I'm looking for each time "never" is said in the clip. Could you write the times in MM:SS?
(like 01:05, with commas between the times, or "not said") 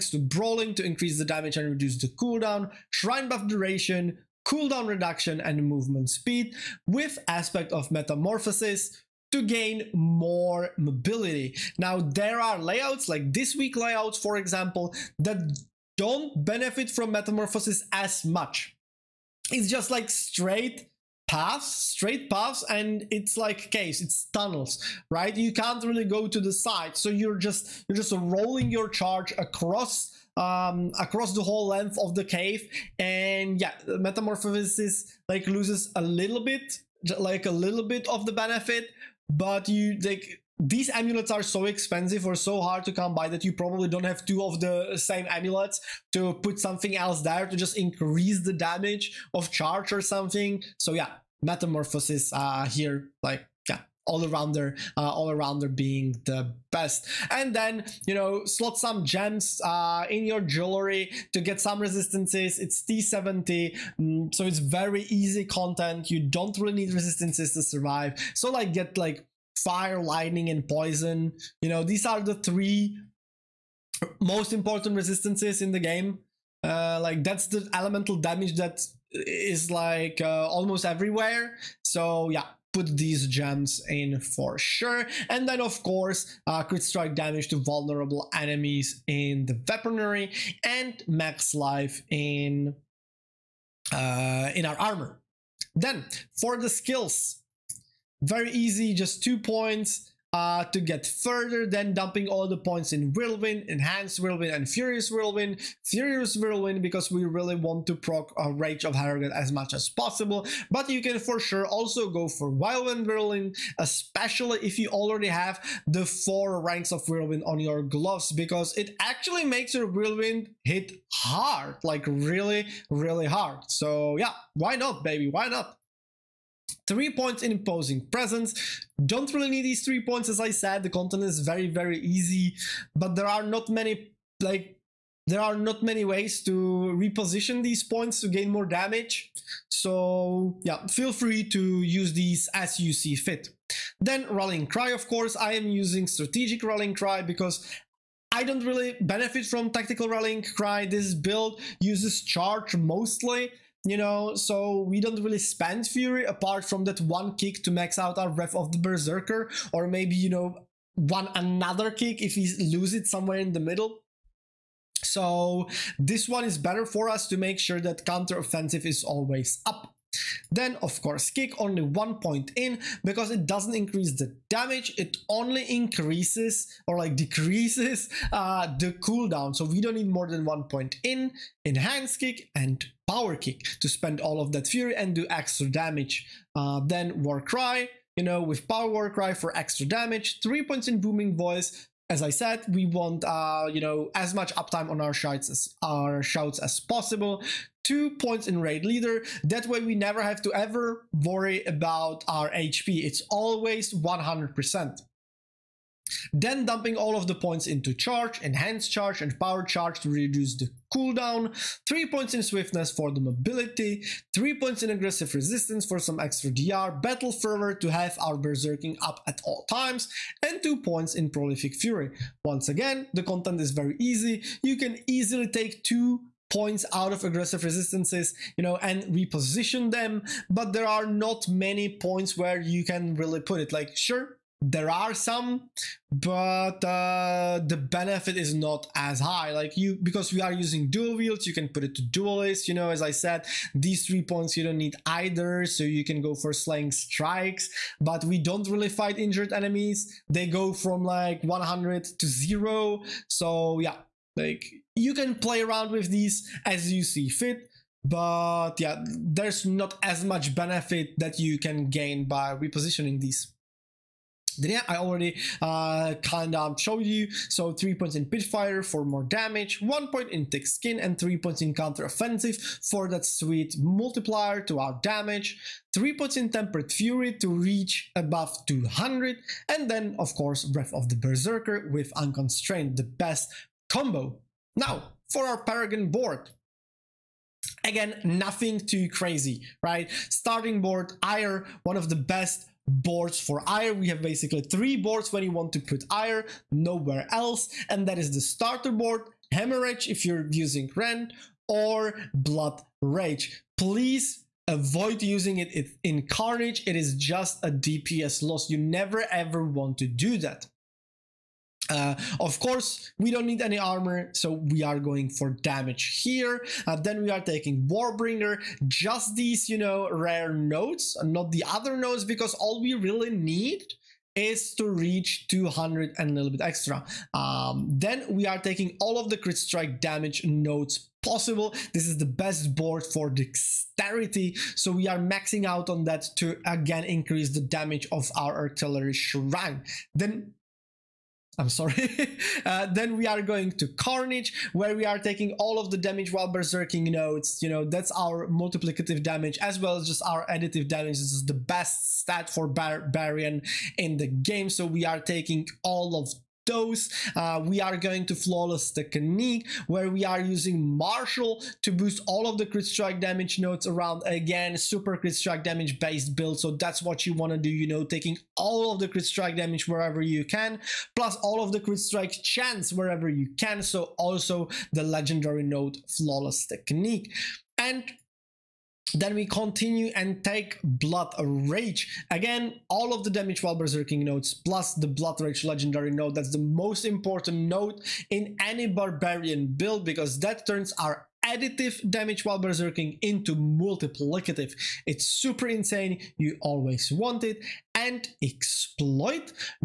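03:19, 05:08.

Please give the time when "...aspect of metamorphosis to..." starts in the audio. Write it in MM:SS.
00:07.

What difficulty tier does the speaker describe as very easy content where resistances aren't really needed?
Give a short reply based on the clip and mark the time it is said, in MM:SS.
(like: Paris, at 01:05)
T70, at 01:02.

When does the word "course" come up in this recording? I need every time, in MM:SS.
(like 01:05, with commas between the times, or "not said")
01:25, 02:25, 02:51, 04:40, 05:12.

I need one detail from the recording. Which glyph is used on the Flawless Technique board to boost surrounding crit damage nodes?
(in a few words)
Marshal.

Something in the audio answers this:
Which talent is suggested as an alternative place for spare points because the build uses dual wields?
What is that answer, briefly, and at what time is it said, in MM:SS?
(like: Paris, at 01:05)
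Duelist, at 04:02.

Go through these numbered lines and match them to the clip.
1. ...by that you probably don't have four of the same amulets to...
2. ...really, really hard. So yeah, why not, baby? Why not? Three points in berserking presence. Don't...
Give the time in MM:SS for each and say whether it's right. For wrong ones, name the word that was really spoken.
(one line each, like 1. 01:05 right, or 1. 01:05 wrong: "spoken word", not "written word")
1. 00:43 wrong: "two", not "four"
2. 02:02 wrong: "imposing", not "berserking".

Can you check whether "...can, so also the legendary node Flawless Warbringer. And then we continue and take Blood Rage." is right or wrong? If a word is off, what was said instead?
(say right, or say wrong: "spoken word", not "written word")
wrong: "Technique", not "Warbringer".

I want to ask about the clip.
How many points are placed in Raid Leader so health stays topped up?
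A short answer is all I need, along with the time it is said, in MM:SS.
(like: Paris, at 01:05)
2, at 03:17.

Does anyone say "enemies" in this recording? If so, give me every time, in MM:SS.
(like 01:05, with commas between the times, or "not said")
01:28, 04:09.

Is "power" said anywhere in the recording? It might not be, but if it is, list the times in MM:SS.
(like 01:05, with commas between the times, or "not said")
03:03, 03:08, 03:29.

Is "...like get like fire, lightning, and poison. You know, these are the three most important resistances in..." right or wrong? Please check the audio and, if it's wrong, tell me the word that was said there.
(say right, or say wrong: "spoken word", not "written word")
right.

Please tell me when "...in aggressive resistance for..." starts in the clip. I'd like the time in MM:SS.
03:34.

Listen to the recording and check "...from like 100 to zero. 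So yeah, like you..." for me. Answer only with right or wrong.
right.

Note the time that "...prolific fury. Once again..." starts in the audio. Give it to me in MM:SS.
03:41.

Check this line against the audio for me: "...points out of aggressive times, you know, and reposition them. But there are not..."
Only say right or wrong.
wrong.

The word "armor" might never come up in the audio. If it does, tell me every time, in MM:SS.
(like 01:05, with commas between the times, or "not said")
01:34, 05:13.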